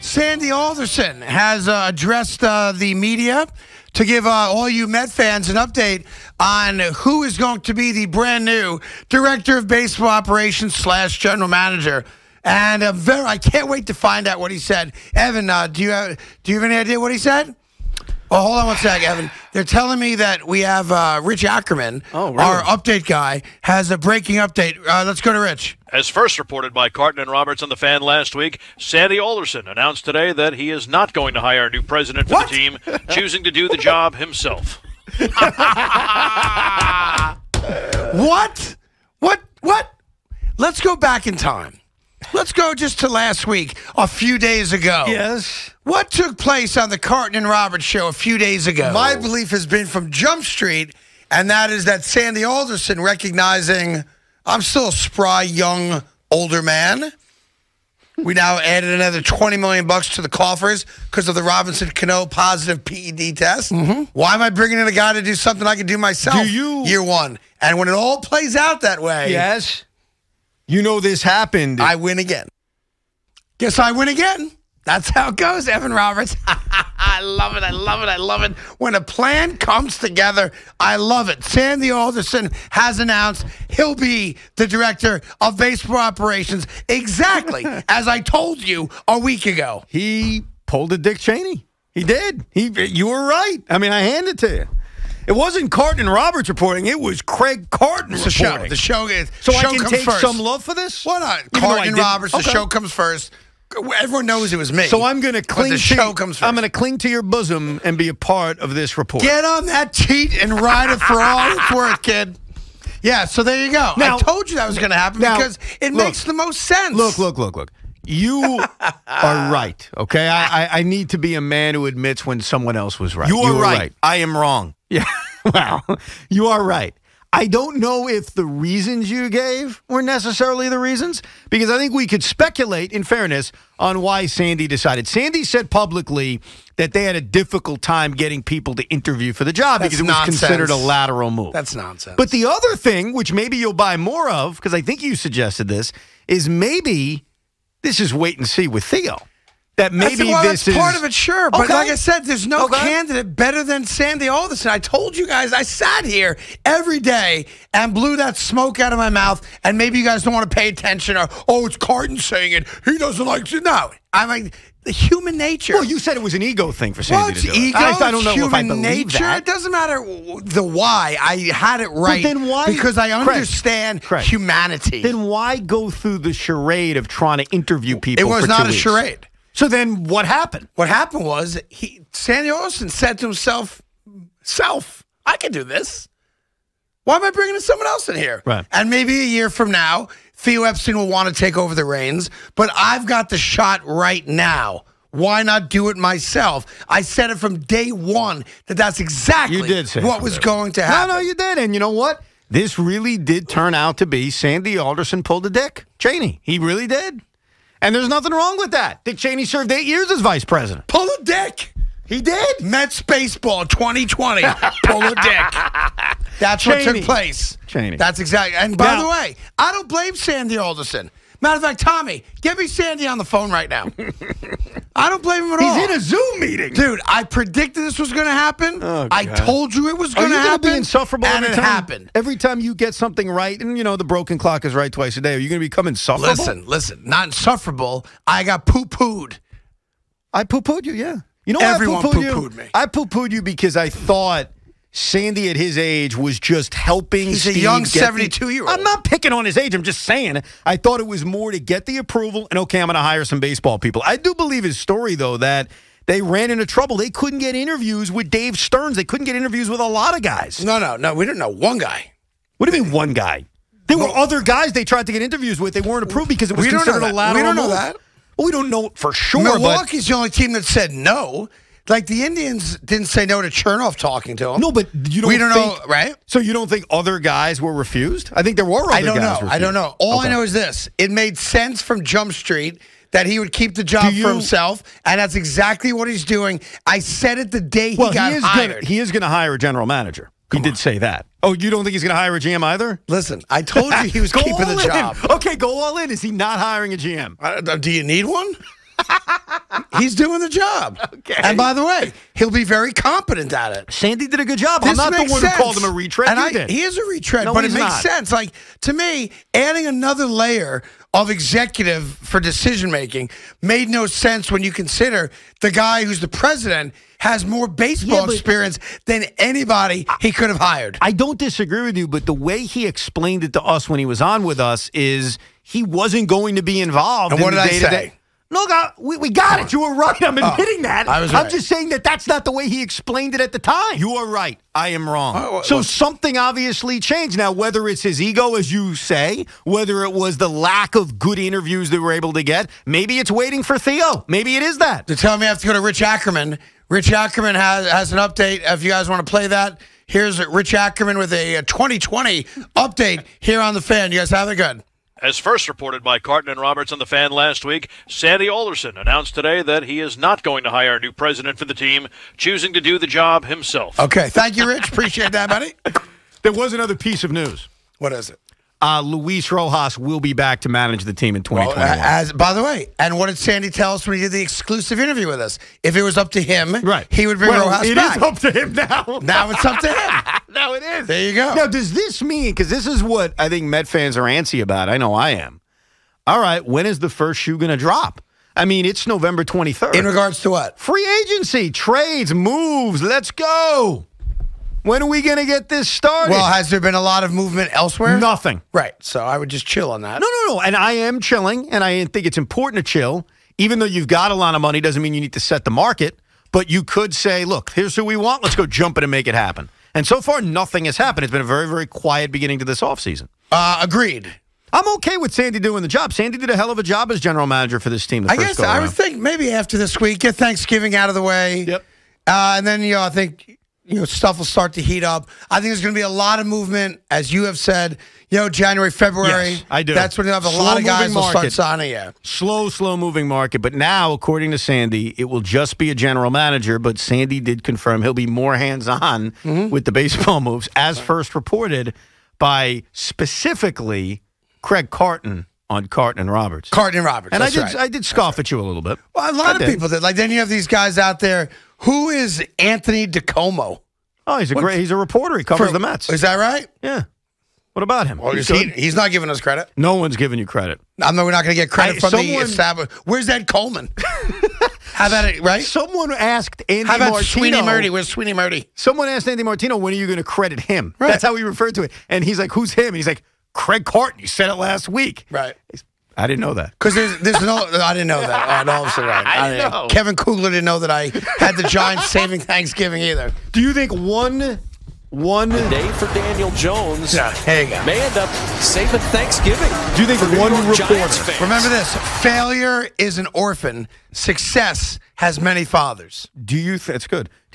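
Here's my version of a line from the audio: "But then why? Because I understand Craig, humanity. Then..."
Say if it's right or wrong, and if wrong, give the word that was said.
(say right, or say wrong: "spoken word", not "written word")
right.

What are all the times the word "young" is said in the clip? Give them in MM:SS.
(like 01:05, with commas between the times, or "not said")
00:55, 04:07.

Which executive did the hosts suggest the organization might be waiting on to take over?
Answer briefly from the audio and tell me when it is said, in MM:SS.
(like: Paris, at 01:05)
Theo Epstein, at 03:10.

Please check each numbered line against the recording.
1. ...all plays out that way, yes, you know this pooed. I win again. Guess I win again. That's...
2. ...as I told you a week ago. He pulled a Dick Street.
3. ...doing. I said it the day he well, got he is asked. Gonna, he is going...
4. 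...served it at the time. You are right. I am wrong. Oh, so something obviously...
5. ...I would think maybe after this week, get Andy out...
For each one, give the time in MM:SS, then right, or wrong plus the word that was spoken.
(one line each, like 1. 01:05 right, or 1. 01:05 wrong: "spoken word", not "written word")
1. 01:07 wrong: "happened", not "pooed"
2. 01:27 wrong: "Cheney", not "Street"
3. 04:46 wrong: "hired", not "asked"
4. 05:32 wrong: "explained", not "served"
5. 06:58 wrong: "Thanksgiving", not "Andy".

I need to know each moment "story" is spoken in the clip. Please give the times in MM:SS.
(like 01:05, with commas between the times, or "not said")
04:14.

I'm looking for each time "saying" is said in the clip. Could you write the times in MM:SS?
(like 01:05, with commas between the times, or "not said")
02:42, 04:10, 05:31.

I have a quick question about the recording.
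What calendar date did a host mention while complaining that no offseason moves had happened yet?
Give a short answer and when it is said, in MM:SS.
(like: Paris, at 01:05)
November 23rd, at 06:29.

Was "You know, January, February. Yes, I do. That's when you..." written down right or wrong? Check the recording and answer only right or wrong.
right.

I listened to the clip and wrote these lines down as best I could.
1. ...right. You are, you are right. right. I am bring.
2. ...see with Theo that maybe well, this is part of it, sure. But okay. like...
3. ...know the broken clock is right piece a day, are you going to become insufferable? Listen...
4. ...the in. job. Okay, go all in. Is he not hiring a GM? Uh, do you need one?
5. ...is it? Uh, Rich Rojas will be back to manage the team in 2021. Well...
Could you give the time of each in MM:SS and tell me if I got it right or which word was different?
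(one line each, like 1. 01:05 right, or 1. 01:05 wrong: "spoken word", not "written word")
1. 02:03 wrong: "wrong", not "bring"
2. 02:28 right
3. 03:53 wrong: "twice", not "piece"
4. 04:54 right
5. 06:08 wrong: "Luis", not "Rich".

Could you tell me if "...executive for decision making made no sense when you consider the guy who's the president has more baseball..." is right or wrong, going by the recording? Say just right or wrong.
right.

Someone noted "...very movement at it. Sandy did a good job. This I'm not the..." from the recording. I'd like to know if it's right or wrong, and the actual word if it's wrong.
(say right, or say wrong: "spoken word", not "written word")
wrong: "competent", not "movement".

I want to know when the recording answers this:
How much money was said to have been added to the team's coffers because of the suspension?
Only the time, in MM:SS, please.
00:59.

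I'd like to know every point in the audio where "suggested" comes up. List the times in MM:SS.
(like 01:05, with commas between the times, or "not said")
02:25.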